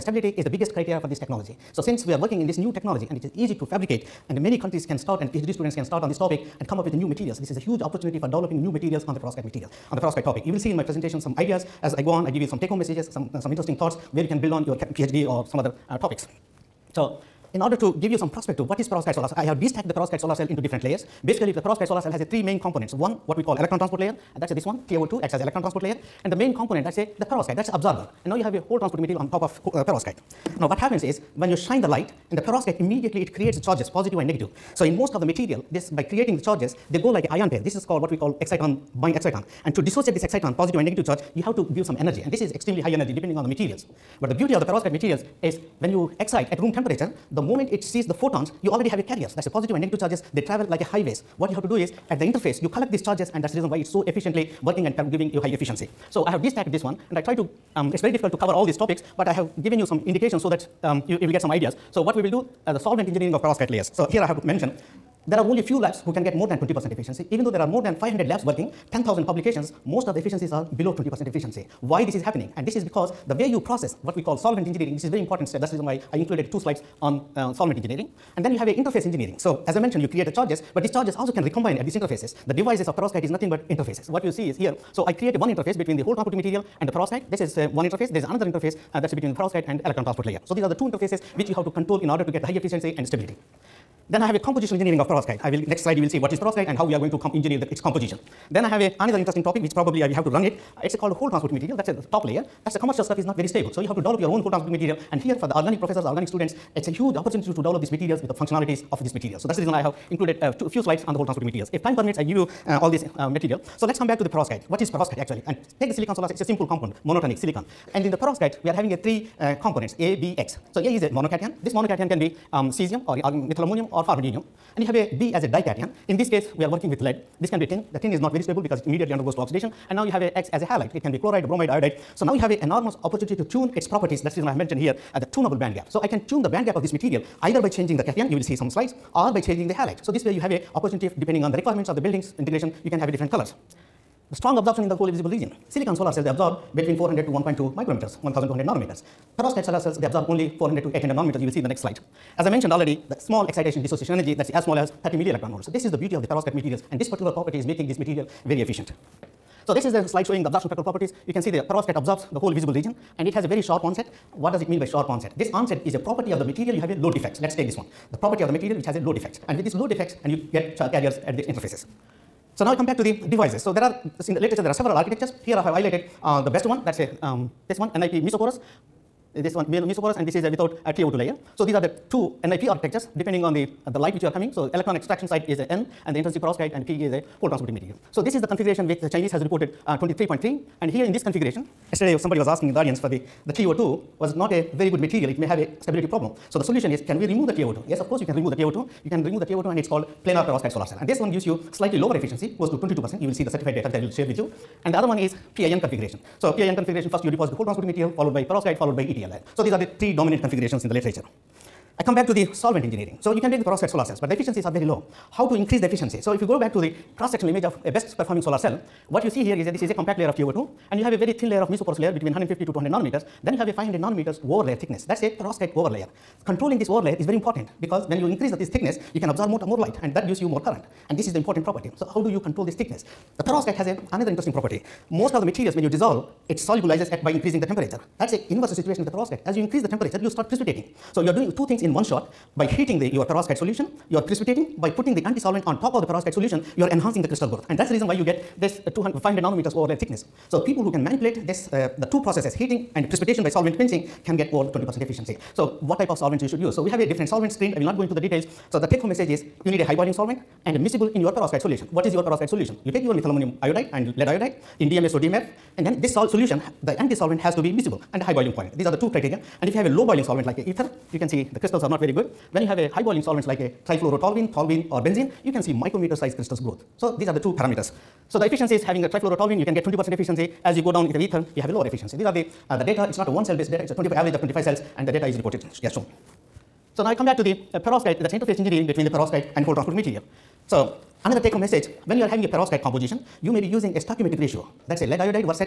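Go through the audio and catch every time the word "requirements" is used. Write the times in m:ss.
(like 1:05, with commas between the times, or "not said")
2:21.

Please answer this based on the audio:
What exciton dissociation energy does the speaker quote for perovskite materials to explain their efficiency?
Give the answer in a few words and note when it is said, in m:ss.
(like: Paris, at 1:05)
30 millielectron volts, at 2:35.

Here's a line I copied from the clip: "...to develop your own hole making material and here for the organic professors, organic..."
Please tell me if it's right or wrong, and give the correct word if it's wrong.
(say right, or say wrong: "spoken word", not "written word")
wrong: "transporting", not "making".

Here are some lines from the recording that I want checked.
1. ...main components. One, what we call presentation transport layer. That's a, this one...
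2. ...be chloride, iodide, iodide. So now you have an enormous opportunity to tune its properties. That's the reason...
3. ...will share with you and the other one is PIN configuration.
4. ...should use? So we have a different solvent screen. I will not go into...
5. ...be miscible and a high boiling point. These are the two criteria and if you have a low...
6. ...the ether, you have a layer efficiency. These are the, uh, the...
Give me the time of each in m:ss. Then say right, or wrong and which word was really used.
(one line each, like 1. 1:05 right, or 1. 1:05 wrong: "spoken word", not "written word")
1. 0:22 wrong: "electron", not "presentation"
2. 2:11 wrong: "bromide", not "iodide"
3. 3:23 right
4. 4:16 right
5. 4:27 right
6. 4:41 wrong: "lower", not "layer".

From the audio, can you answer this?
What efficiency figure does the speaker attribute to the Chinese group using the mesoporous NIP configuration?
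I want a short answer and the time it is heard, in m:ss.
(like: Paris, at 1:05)
23.3, at 3:09.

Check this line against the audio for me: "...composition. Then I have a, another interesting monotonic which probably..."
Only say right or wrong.
wrong.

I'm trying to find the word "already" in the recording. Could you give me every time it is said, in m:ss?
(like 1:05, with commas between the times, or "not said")
0:48, 2:32.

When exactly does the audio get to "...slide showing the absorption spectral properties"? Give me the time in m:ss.
2:40.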